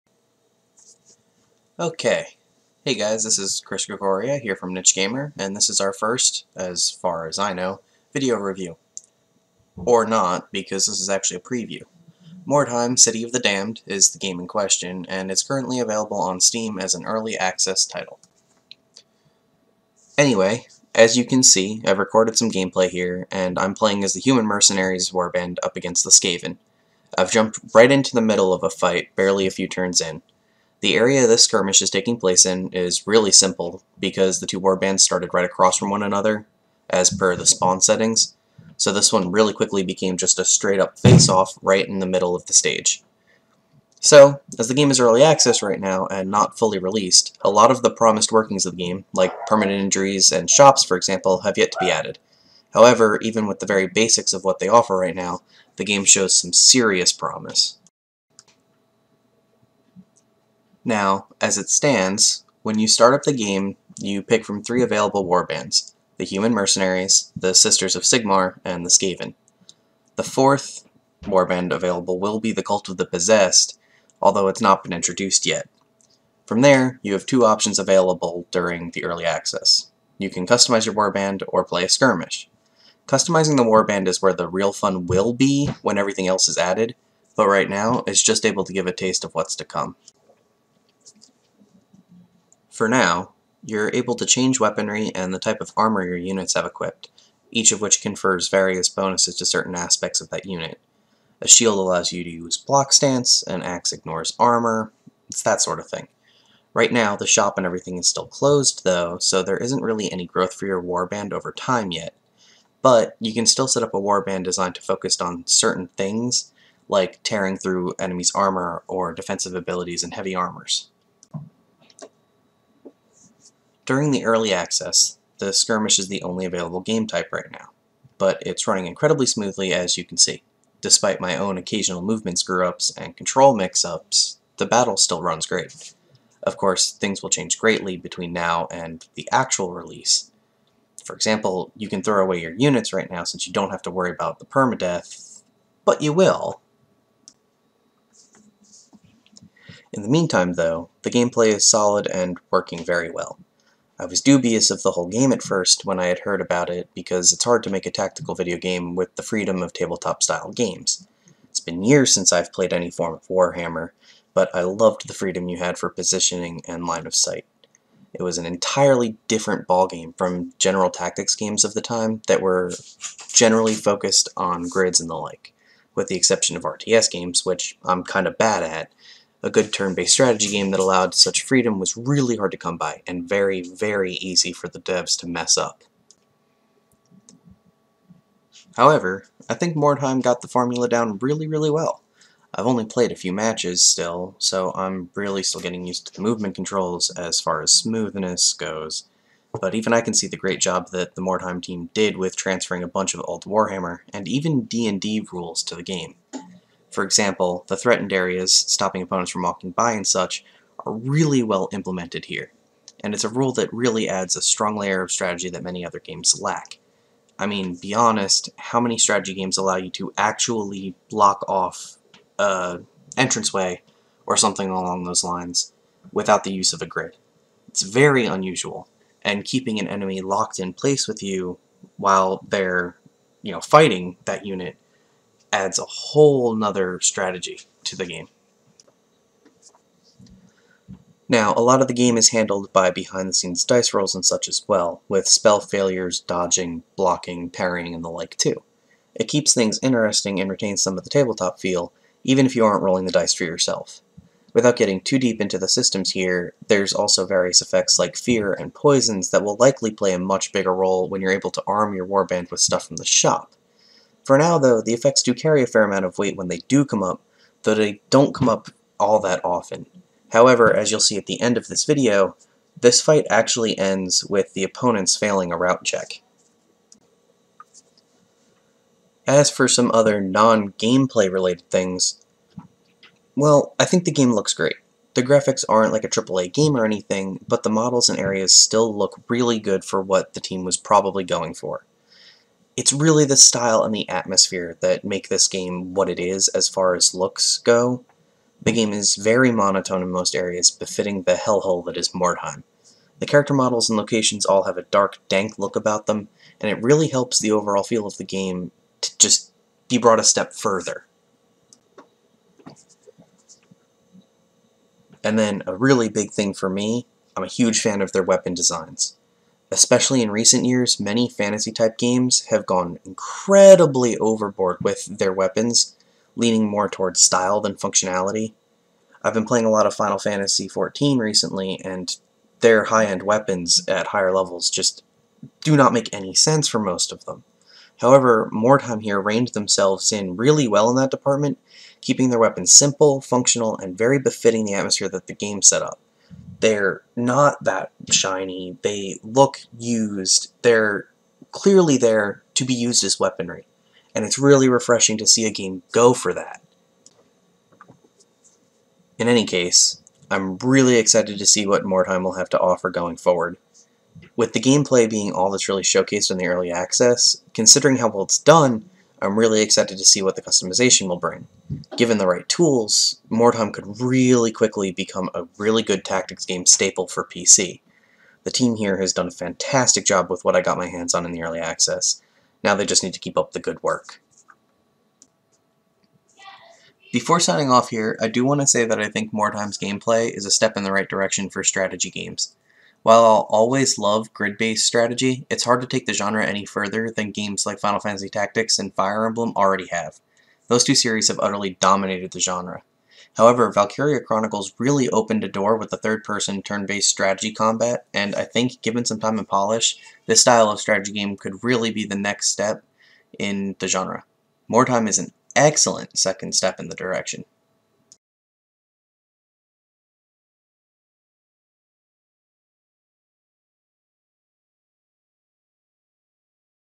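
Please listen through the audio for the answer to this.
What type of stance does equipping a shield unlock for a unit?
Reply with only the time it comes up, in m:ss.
1:42.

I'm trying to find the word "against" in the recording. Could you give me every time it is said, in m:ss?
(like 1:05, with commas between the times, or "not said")
0:25.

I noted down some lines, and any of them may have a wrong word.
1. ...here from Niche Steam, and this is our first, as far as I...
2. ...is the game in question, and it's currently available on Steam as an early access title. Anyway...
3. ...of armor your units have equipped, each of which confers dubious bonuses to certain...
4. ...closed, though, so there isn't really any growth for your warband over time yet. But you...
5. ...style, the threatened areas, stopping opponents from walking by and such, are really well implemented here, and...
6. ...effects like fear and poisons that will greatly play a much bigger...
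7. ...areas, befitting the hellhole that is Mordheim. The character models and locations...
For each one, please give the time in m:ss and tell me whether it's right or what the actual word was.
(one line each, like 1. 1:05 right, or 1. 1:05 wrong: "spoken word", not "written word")
1. 0:04 wrong: "Gamer", not "Steam"
2. 0:13 right
3. 1:35 wrong: "various", not "dubious"
4. 1:48 right
5. 3:27 wrong: "example", not "style"
6. 4:17 wrong: "likely", not "greatly"
7. 5:00 right.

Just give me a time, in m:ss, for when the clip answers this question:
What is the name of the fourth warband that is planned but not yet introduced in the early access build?
1:12.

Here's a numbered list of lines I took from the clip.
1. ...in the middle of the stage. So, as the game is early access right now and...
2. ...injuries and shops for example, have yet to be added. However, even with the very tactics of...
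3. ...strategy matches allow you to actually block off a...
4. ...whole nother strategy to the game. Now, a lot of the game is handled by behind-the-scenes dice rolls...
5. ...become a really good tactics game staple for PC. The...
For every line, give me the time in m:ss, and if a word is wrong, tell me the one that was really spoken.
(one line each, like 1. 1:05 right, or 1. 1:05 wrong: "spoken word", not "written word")
1. 0:41 right
2. 0:49 wrong: "basics", not "tactics"
3. 3:38 wrong: "games", not "matches"
4. 3:55 right
5. 6:14 right.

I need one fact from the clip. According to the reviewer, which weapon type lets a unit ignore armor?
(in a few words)
An axe.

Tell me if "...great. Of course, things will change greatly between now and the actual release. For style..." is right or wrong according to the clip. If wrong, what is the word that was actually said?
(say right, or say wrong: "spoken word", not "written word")
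wrong: "example", not "style".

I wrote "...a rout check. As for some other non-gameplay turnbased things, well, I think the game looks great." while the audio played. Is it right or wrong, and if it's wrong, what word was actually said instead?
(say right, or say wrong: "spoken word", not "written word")
wrong: "related", not "turnbased".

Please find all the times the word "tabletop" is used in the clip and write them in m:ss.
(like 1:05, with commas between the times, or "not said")
2:39, 4:11.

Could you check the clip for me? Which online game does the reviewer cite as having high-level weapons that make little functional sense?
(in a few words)
Final Fantasy XIV.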